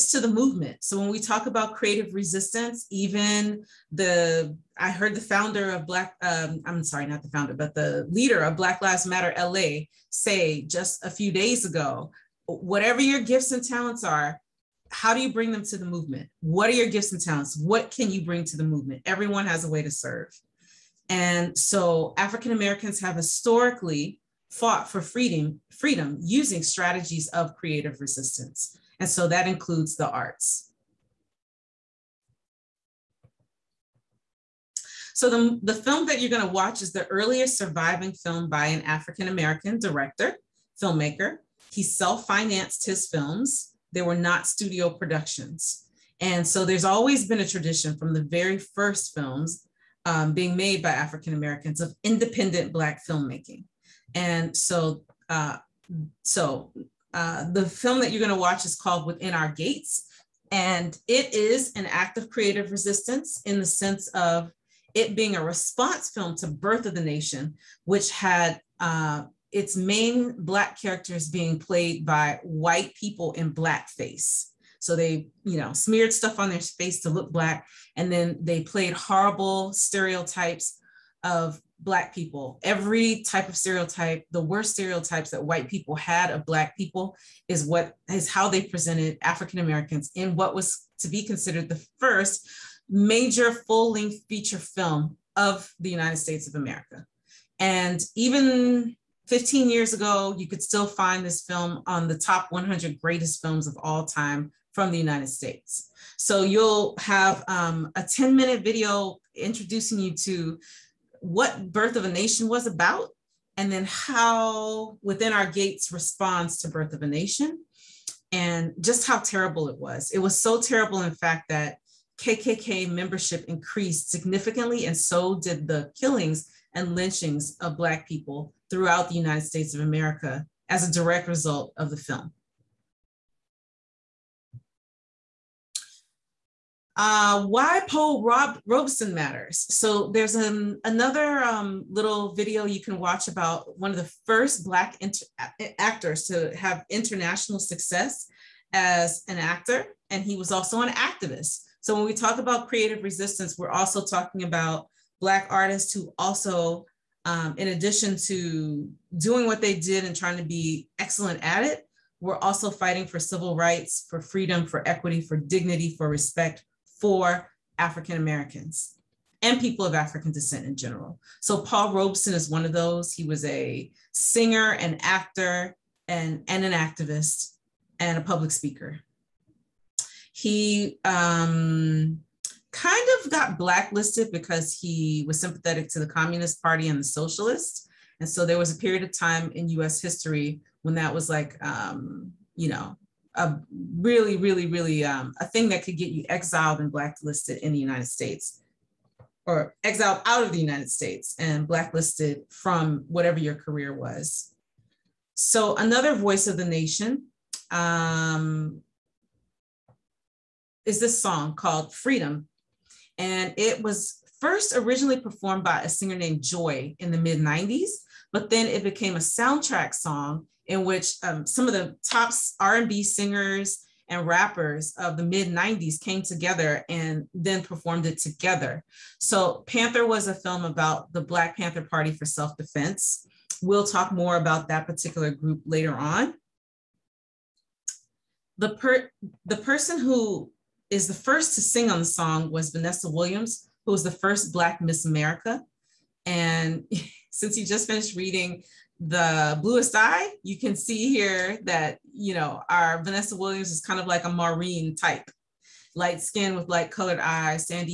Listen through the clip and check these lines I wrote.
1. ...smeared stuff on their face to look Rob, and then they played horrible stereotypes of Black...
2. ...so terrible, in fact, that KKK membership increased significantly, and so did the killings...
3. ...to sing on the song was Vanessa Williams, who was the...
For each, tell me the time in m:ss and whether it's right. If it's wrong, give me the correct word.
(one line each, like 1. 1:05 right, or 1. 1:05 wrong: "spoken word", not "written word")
1. 1:15 wrong: "Black", not "Rob"
2. 2:00 right
3. 4:01 right.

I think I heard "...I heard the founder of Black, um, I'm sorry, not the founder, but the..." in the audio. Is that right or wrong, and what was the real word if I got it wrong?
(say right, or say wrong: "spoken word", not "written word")
right.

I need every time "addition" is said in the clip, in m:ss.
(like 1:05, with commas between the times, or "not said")
2:37.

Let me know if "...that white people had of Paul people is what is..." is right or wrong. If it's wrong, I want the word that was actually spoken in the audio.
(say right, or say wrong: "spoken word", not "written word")
wrong: "Black", not "Paul".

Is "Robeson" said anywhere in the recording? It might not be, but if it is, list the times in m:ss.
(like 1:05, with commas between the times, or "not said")
2:18, 2:51.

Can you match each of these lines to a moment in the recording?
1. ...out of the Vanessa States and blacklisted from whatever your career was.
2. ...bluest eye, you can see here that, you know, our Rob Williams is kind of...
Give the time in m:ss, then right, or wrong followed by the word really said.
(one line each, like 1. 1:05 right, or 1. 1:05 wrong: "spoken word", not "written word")
1. 3:20 wrong: "United", not "Vanessa"
2. 4:09 wrong: "Vanessa", not "Rob".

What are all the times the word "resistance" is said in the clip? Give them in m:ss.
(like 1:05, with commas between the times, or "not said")
0:02, 0:28, 1:02, 2:33.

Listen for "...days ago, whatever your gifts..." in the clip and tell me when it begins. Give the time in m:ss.
0:11.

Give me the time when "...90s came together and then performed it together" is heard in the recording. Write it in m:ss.
3:45.